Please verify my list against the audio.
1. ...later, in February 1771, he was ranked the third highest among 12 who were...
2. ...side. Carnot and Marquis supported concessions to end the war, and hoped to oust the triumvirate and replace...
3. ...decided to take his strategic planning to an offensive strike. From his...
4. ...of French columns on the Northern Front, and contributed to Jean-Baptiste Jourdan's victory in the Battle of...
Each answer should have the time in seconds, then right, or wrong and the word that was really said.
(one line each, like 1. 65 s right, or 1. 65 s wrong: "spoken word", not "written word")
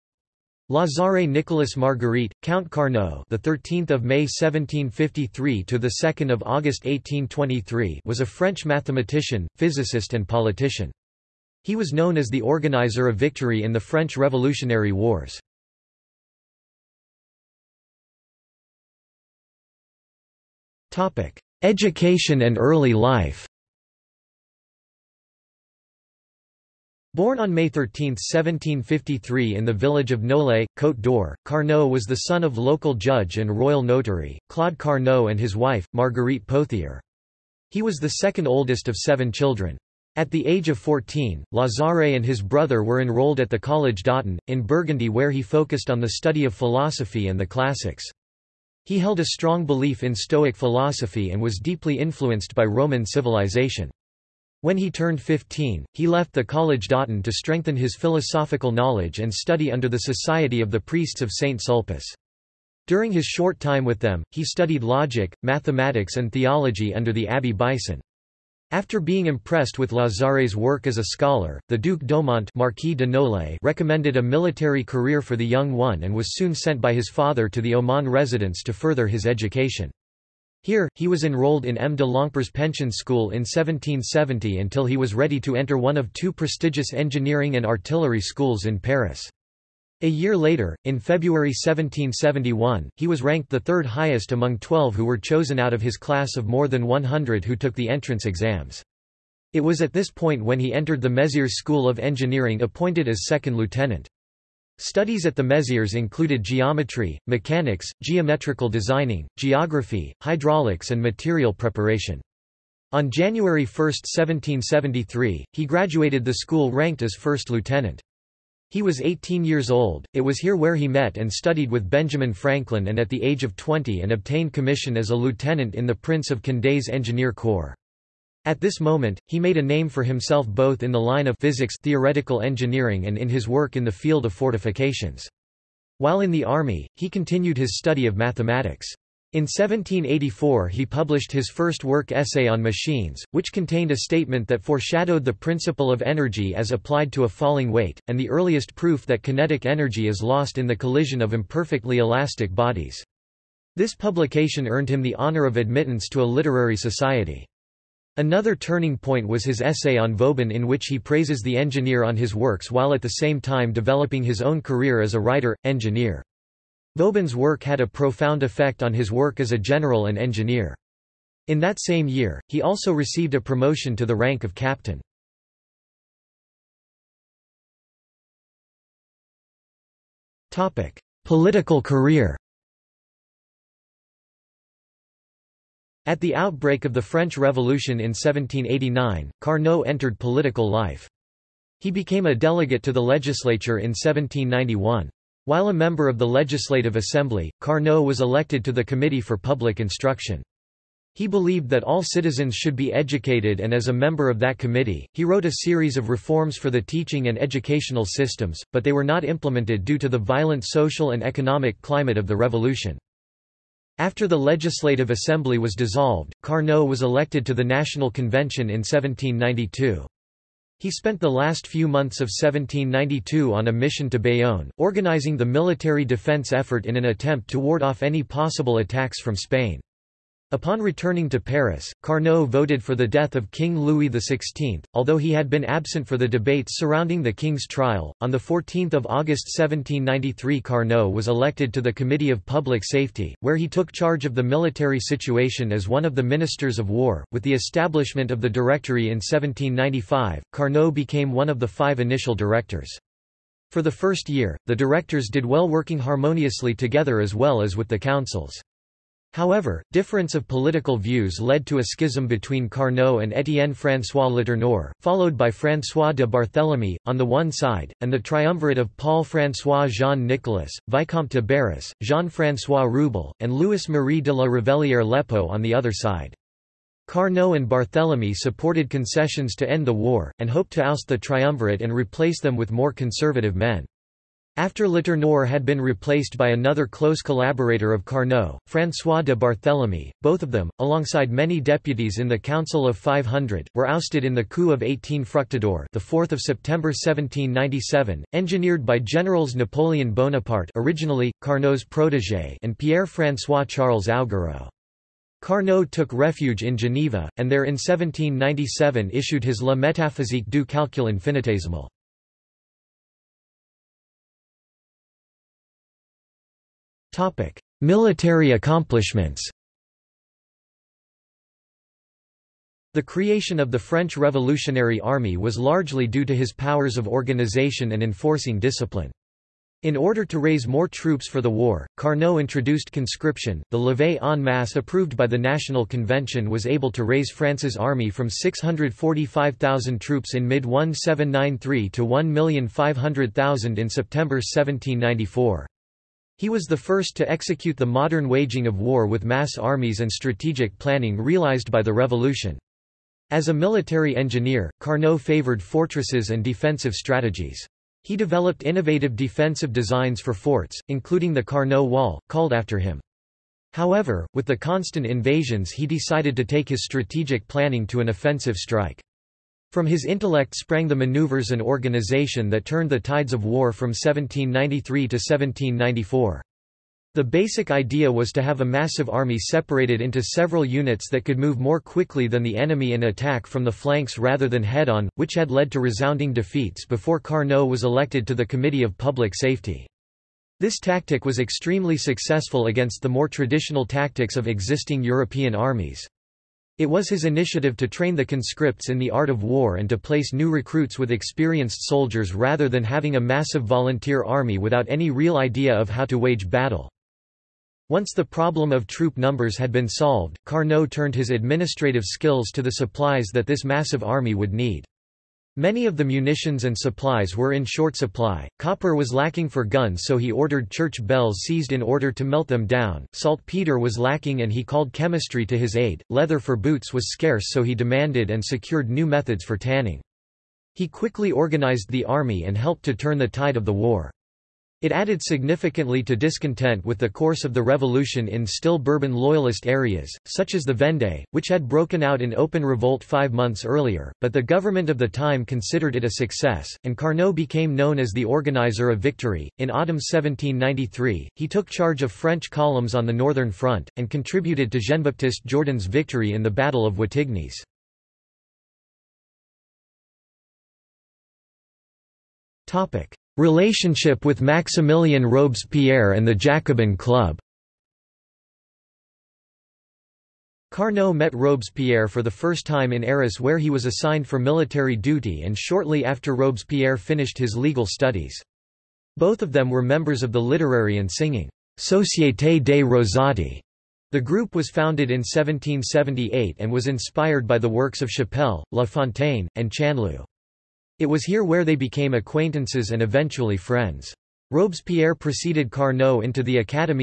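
1. 90 s right
2. 275 s wrong: "Barthélemy", not "Marquis"
3. 365 s right
4. 452 s right.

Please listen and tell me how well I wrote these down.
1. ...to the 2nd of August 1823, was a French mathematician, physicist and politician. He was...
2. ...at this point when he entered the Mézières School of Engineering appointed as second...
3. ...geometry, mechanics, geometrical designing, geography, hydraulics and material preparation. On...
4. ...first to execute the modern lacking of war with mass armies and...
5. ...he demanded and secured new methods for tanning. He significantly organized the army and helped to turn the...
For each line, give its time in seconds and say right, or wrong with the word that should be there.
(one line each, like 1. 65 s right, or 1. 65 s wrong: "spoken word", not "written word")
1. 5 s right
2. 99 s right
3. 106 s right
4. 346 s wrong: "waging", not "lacking"
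5. 427 s wrong: "quickly", not "significantly".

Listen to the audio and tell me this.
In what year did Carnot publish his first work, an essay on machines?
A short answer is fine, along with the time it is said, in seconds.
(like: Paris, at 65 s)
1784, at 139 s.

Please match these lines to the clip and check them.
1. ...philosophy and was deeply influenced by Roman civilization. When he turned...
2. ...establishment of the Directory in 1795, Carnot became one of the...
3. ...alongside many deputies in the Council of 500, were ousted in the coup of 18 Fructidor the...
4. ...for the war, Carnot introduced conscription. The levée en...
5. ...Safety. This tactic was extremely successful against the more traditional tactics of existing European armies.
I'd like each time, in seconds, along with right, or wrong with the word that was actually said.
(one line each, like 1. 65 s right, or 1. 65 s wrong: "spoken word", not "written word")
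1. 50 s right
2. 247 s right
3. 290 s right
4. 331 s right
5. 389 s right.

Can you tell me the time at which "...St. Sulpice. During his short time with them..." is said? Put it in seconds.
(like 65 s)
61 s.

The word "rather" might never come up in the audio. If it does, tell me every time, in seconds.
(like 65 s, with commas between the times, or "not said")
384 s, 402 s.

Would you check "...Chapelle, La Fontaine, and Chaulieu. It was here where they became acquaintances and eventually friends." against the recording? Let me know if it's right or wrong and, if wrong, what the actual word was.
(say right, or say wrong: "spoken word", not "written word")
right.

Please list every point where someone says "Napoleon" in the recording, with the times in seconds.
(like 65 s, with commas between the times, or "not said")
299 s.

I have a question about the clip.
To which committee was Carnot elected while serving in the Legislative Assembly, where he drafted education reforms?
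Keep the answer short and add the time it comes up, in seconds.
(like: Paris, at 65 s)
Committee for Public Instruction, at 198 s.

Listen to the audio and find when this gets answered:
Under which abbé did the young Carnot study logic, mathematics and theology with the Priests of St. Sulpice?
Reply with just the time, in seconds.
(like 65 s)
67 s.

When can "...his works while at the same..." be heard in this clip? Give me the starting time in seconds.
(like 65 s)
162 s.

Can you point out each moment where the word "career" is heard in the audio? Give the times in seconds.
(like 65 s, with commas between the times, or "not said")
74 s, 164 s, 181 s.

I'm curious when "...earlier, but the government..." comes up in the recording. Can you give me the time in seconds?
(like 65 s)
443 s.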